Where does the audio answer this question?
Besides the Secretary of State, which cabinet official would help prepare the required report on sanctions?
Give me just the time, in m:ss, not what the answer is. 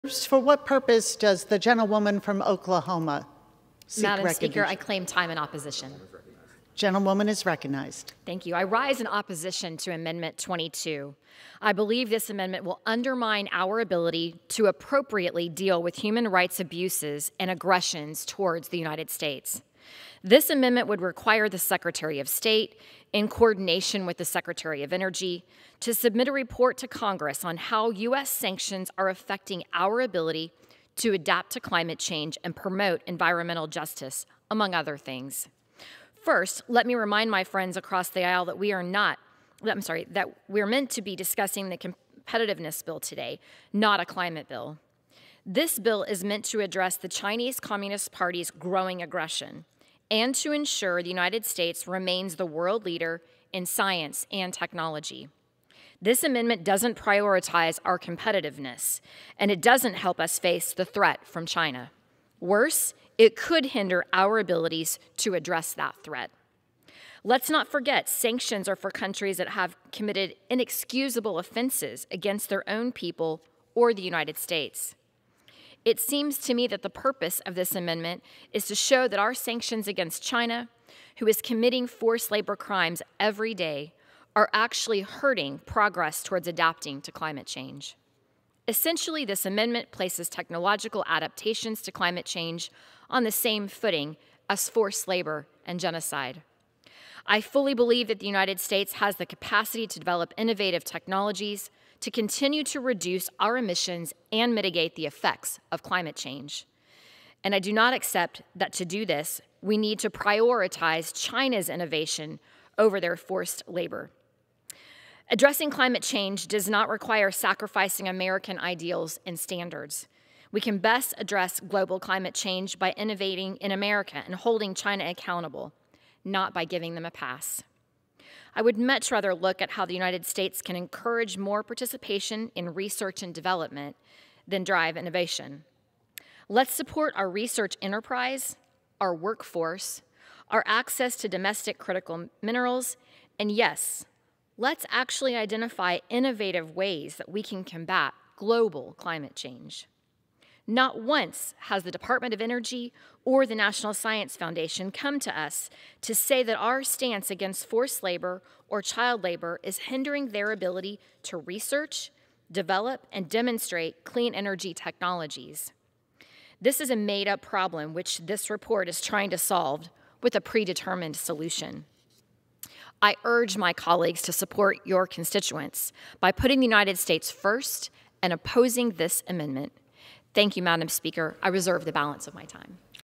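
0:24.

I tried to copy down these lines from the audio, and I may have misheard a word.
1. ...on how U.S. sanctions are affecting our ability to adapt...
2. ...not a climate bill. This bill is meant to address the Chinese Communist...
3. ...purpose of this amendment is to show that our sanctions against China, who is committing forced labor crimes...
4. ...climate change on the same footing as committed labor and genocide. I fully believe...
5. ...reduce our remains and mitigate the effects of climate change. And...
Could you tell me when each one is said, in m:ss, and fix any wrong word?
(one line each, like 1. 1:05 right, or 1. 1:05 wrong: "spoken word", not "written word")
1. 0:27 right
2. 0:43 right
3. 1:16 right
4. 1:31 wrong: "forced", not "committed"
5. 1:42 wrong: "emissions", not "remains".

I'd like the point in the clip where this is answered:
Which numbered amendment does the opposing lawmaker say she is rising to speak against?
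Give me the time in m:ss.
0:09.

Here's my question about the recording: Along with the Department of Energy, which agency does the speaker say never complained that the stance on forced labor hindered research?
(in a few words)
National Science Foundation.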